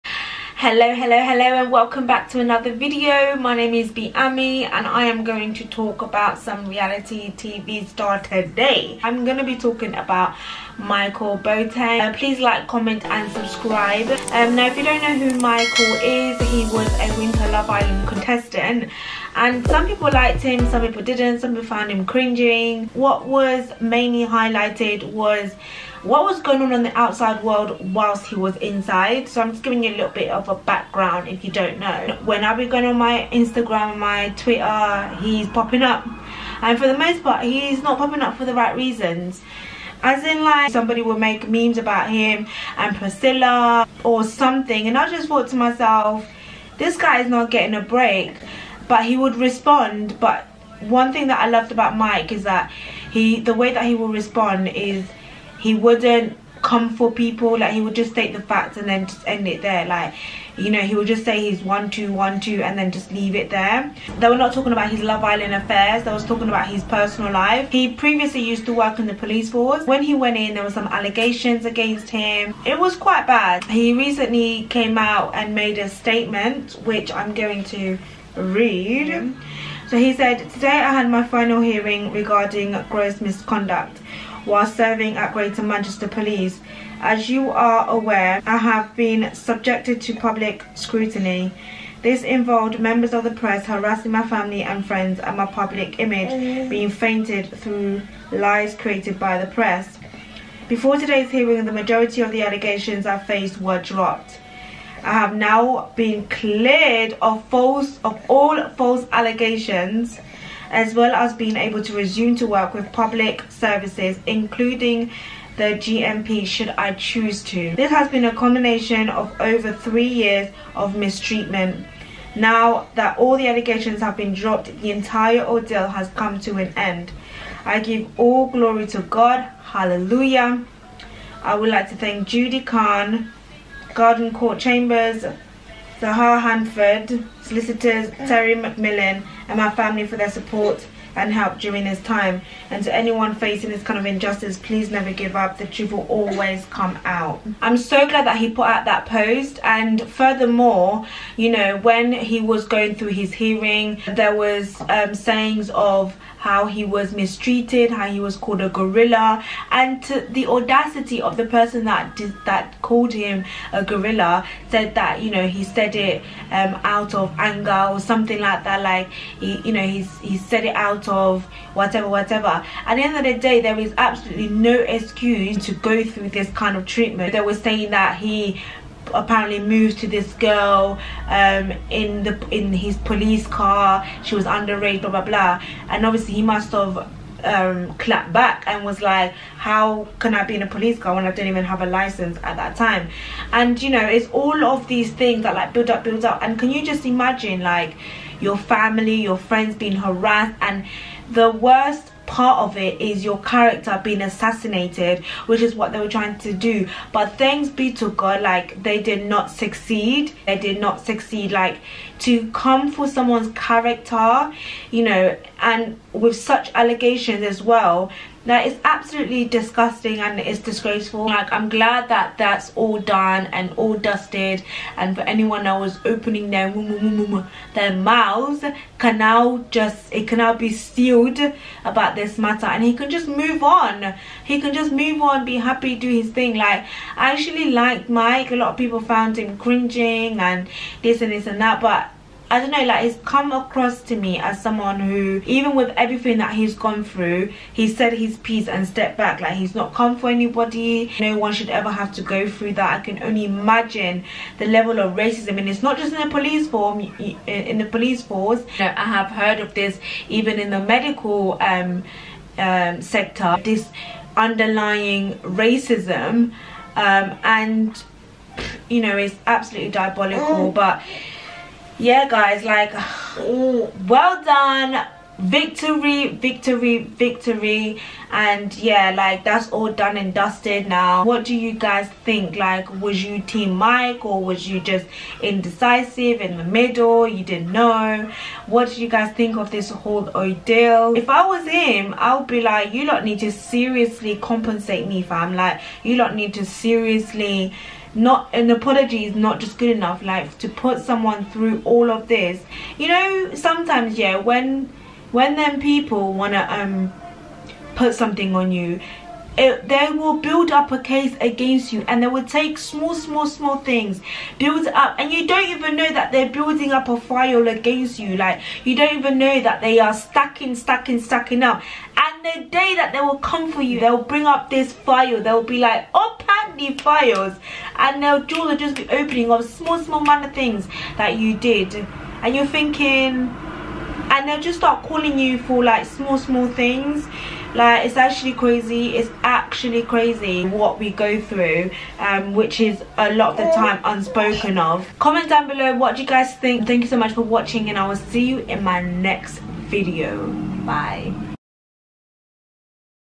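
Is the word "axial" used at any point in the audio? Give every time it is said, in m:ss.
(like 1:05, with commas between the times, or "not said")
not said.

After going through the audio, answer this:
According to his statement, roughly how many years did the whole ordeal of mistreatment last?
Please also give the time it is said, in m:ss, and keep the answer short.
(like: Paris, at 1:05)
Over 3 years, at 1:59.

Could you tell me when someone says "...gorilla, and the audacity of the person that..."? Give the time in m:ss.
2:38.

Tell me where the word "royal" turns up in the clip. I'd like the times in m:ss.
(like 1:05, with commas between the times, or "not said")
not said.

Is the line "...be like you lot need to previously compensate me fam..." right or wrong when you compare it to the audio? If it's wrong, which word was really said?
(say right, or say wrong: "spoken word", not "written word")
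wrong: "seriously", not "previously".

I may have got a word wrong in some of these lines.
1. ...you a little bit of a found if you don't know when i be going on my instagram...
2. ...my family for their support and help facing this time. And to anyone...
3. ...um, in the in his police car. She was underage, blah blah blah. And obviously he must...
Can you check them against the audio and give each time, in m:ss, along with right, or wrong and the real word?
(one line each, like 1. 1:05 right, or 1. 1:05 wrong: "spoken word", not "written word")
1. 0:29 wrong: "background", not "found"
2. 2:19 wrong: "during", not "facing"
3. 3:01 right.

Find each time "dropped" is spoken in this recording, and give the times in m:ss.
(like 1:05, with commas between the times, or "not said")
1:43, 2:04.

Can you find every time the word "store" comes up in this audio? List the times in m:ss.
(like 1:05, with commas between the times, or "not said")
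not said.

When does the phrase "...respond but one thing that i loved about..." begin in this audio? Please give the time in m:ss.
0:49.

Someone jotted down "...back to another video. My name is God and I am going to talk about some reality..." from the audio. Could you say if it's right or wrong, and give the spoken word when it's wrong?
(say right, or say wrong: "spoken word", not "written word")
wrong: "BeAmie", not "God".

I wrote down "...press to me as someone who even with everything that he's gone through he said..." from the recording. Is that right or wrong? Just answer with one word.
wrong.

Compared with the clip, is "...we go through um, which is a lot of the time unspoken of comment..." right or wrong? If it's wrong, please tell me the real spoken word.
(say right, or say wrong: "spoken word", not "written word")
right.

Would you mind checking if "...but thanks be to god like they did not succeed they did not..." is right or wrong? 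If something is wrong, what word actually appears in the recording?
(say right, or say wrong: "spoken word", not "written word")
right.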